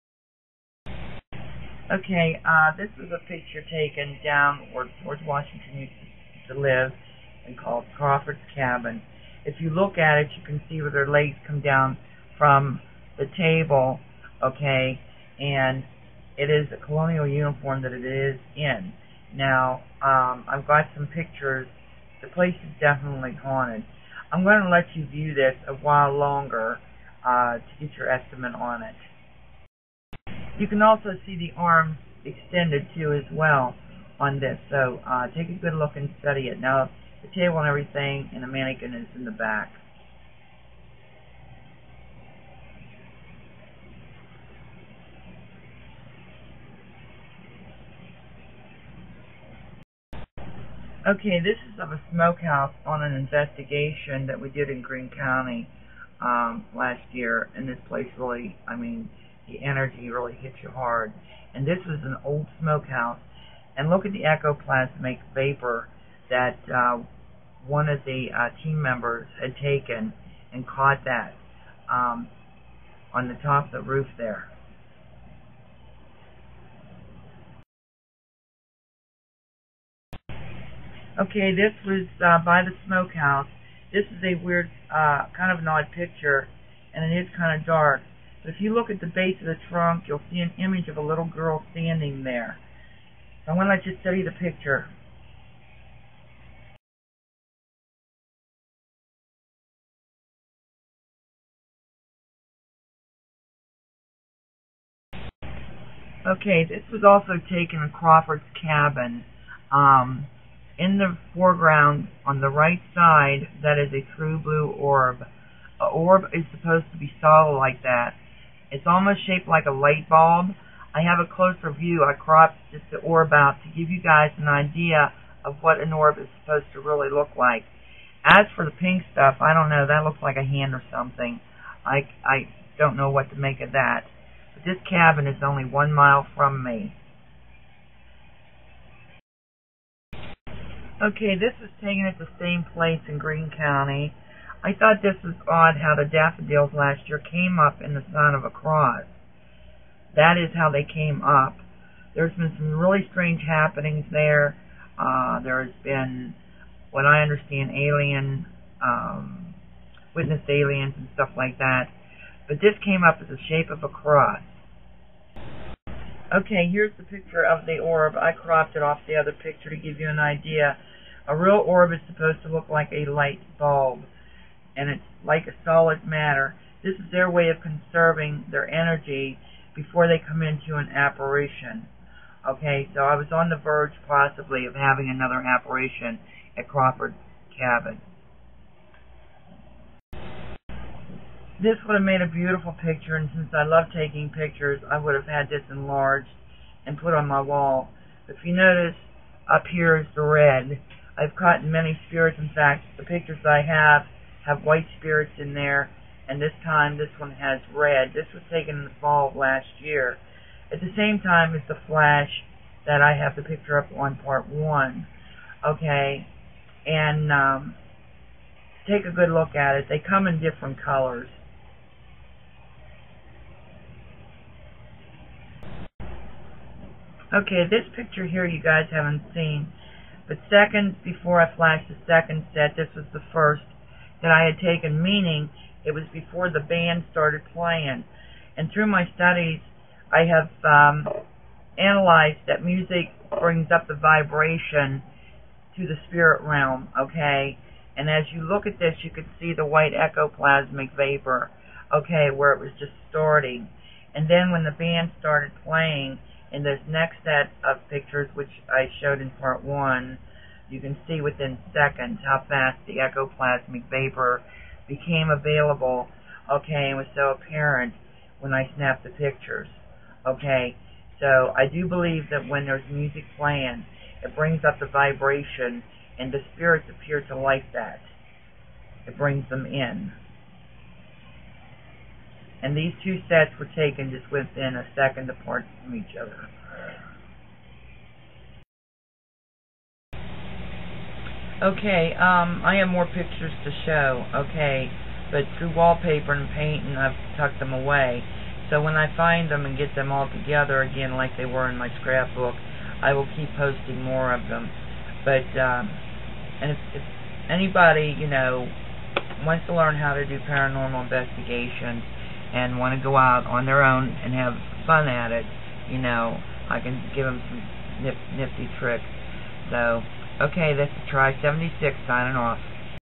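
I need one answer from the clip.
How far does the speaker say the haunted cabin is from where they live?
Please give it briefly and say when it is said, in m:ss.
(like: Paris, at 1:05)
1 mile, at 2:15.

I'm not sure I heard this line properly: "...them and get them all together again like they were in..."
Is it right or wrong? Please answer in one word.
right.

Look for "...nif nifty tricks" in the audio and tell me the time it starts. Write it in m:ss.
5:18.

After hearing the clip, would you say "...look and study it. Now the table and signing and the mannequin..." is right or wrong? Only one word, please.
wrong.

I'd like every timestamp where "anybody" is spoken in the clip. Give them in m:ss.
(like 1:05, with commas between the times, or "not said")
5:07.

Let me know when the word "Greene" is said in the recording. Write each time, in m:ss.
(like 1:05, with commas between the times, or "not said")
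0:54, 2:23.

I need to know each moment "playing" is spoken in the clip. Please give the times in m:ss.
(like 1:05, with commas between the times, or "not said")
3:57, 4:15, 4:33.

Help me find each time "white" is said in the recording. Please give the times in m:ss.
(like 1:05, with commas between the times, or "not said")
3:24, 4:09.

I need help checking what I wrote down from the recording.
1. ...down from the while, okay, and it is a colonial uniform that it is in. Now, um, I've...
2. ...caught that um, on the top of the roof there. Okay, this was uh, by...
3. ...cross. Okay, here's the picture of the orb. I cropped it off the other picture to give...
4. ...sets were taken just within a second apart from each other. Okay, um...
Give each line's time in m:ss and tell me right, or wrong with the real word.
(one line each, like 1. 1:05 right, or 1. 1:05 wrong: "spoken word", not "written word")
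1. 0:11 wrong: "table", not "while"
2. 1:10 right
3. 2:43 right
4. 4:43 right.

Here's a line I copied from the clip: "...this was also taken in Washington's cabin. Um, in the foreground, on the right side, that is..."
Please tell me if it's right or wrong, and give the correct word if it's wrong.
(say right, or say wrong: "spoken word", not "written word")
wrong: "Crawford", not "Washington".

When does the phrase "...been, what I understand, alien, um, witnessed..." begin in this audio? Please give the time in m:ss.
2:35.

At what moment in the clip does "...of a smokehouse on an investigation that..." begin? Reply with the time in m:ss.
0:51.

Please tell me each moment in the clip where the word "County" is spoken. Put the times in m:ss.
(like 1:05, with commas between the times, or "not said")
0:55, 2:23.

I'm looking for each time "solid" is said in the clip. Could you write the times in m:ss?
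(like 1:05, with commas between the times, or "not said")
1:57, 2:55.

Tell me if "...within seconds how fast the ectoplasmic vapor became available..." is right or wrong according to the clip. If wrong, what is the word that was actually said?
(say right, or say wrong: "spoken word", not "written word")
right.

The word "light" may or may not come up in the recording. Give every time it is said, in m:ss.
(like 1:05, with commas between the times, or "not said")
1:59, 2:53.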